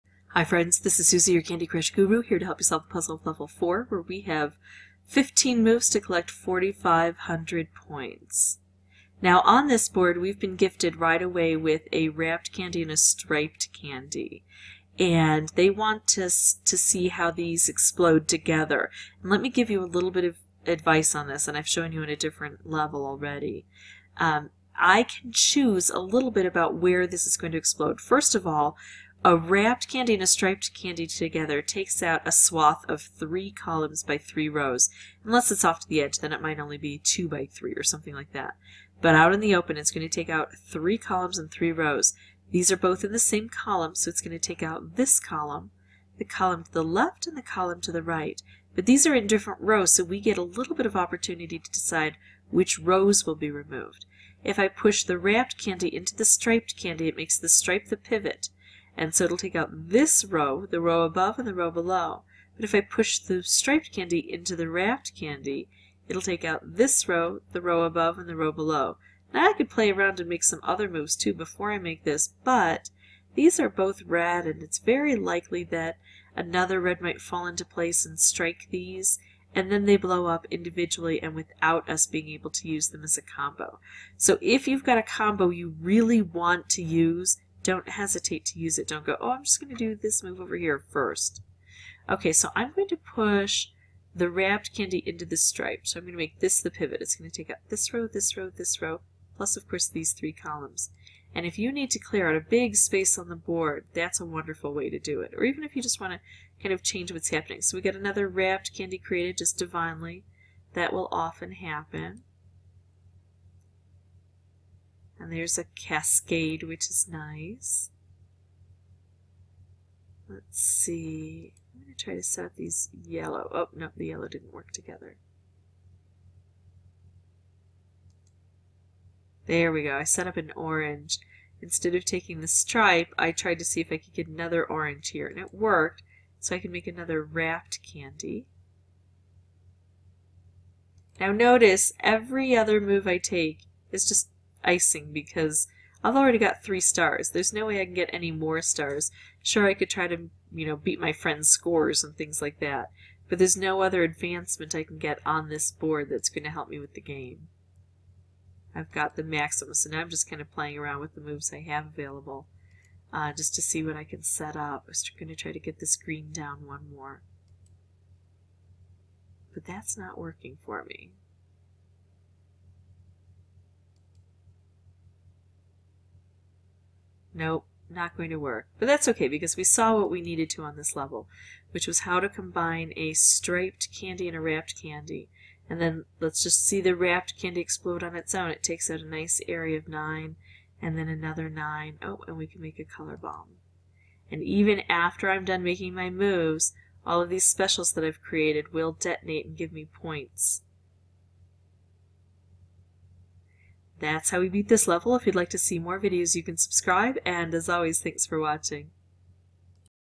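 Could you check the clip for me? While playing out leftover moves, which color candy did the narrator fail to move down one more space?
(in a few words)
Green.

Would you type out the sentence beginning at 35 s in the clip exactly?
Unless it's off to the edge, then it might only be two by three or something like that.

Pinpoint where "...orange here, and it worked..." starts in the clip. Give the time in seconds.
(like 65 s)
134 s.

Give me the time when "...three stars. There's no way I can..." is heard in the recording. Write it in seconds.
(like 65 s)
146 s.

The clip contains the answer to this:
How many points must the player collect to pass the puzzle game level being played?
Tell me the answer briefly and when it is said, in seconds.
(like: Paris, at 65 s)
4,500, at 6 s.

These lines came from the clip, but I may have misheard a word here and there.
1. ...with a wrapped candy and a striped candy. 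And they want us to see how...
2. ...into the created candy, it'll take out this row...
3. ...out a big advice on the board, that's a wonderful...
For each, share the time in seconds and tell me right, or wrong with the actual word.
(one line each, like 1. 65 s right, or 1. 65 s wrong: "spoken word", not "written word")
1. 11 s right
2. 64 s wrong: "wrapped", not "created"
3. 102 s wrong: "space", not "advice".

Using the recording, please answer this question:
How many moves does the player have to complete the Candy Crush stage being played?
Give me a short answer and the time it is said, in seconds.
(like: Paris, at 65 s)
15, at 5 s.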